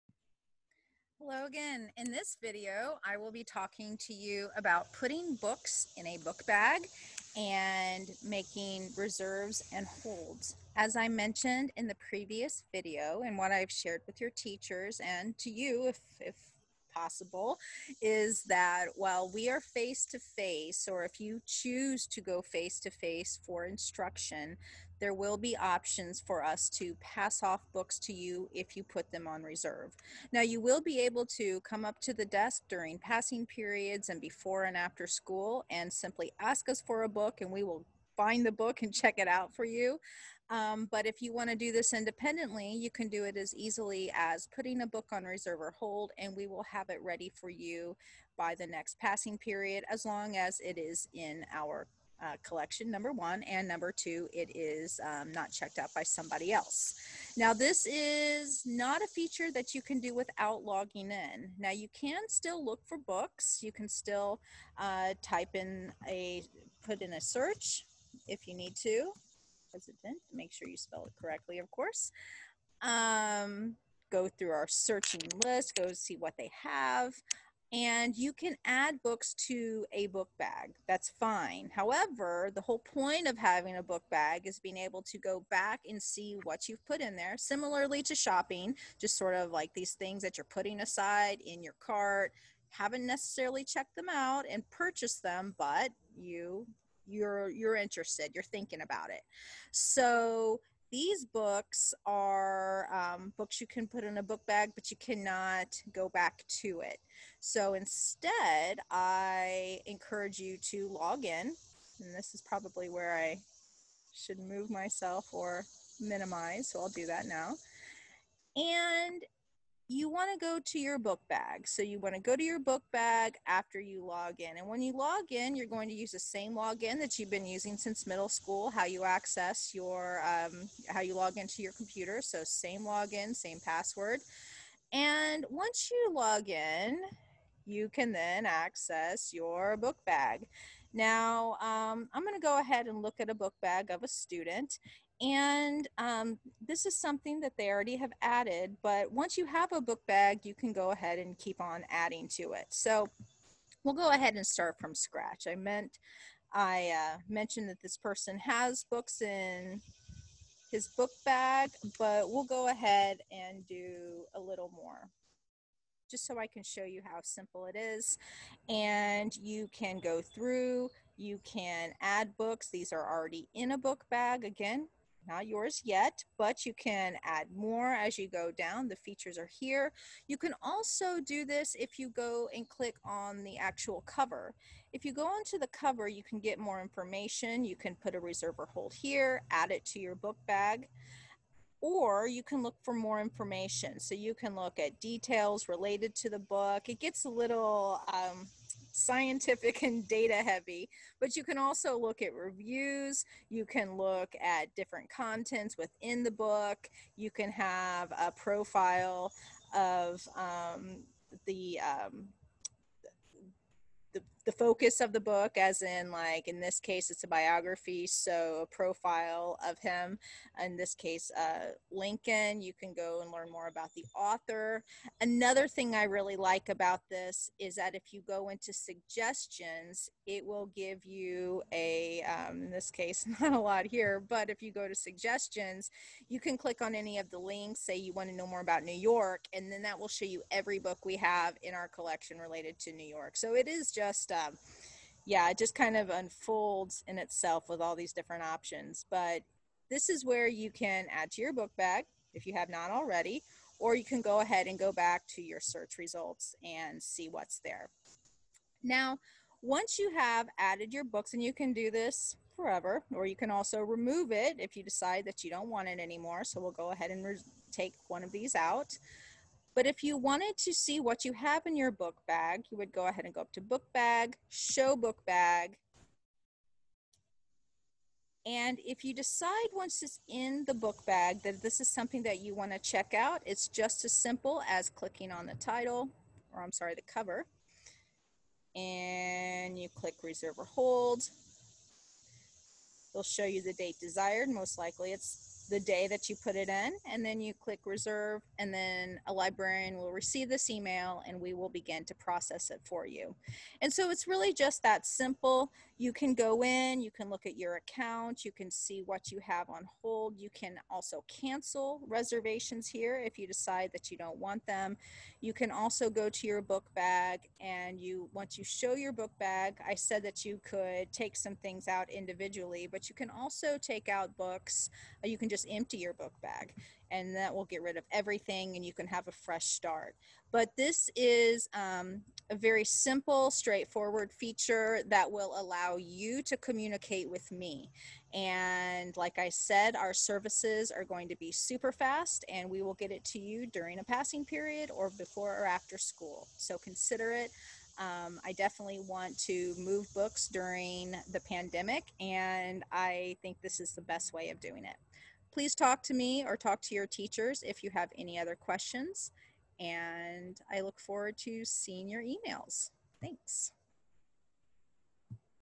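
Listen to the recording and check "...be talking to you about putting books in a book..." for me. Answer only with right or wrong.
right.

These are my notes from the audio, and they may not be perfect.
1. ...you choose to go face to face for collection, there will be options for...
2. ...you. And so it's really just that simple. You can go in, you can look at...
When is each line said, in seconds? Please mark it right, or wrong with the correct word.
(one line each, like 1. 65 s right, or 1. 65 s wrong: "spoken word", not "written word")
1. 21 s wrong: "instruction", not "collection"
2. 303 s right.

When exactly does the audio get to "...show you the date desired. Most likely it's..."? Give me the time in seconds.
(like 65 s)
293 s.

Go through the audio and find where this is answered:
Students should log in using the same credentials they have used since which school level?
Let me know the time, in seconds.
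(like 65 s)
128 s.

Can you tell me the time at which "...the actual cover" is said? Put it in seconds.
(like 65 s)
183 s.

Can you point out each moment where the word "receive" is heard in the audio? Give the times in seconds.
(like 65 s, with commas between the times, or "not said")
300 s.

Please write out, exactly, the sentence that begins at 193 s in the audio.
So you can look at details related to the book.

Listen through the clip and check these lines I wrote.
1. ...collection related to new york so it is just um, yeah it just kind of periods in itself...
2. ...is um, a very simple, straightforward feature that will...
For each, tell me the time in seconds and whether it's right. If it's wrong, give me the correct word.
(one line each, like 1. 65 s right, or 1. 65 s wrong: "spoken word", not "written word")
1. 241 s wrong: "unfolds", not "periods"
2. 331 s right.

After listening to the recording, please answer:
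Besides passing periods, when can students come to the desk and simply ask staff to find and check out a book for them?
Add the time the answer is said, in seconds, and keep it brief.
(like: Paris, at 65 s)
Before and after school, at 34 s.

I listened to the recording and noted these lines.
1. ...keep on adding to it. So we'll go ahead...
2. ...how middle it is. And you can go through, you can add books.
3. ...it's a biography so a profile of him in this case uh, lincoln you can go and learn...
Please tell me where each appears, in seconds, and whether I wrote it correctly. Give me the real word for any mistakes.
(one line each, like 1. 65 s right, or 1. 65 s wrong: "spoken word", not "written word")
1. 151 s right
2. 167 s wrong: "simple", not "middle"
3. 217 s right.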